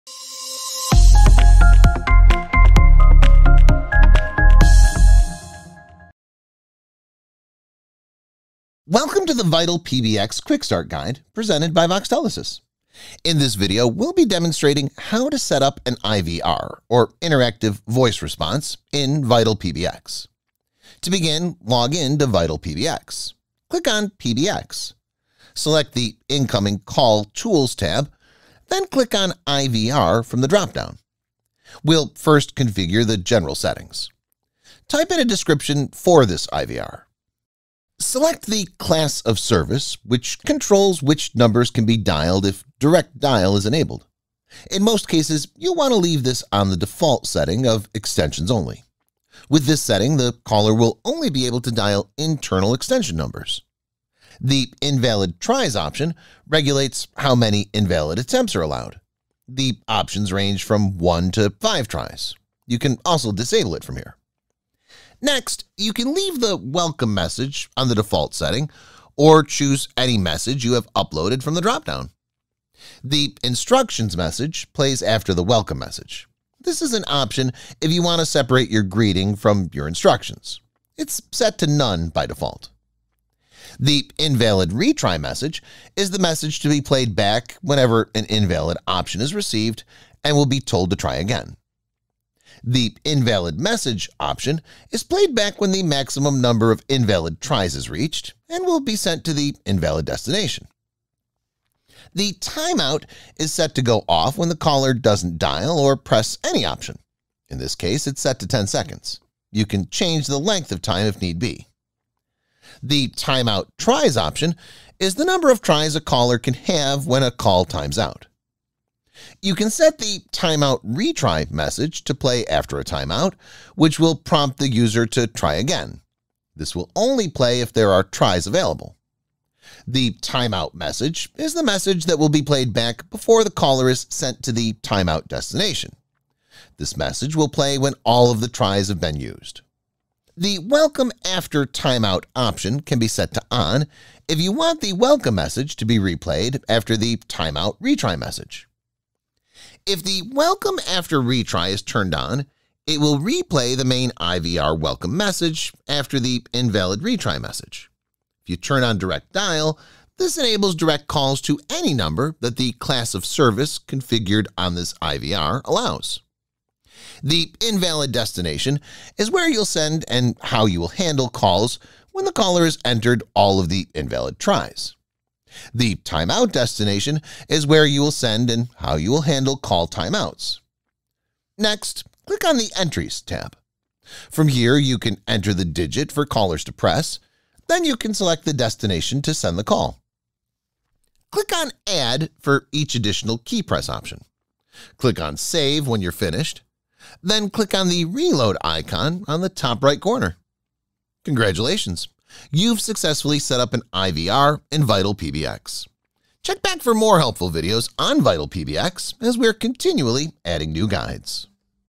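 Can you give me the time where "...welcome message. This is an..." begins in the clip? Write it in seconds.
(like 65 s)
75 s.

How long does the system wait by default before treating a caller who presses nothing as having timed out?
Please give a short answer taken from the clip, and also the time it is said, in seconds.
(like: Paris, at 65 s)
10 seconds, at 108 s.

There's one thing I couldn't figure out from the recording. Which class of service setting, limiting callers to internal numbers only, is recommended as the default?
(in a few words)
Extensions only.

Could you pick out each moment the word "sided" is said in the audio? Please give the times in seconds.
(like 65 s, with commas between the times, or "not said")
not said.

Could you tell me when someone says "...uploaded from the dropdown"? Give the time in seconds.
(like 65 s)
70 s.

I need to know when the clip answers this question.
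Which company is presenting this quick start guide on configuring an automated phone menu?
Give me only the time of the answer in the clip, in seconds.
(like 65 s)
11 s.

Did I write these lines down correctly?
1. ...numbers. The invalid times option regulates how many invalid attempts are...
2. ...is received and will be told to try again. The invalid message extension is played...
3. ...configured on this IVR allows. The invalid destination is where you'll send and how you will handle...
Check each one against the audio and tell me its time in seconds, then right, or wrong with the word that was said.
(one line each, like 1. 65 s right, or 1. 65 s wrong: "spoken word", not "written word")
1. 53 s wrong: "tries", not "times"
2. 89 s wrong: "option", not "extension"
3. 163 s right.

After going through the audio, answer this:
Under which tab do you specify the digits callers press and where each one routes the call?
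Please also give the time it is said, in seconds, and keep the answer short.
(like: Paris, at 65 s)
Entries, at 182 s.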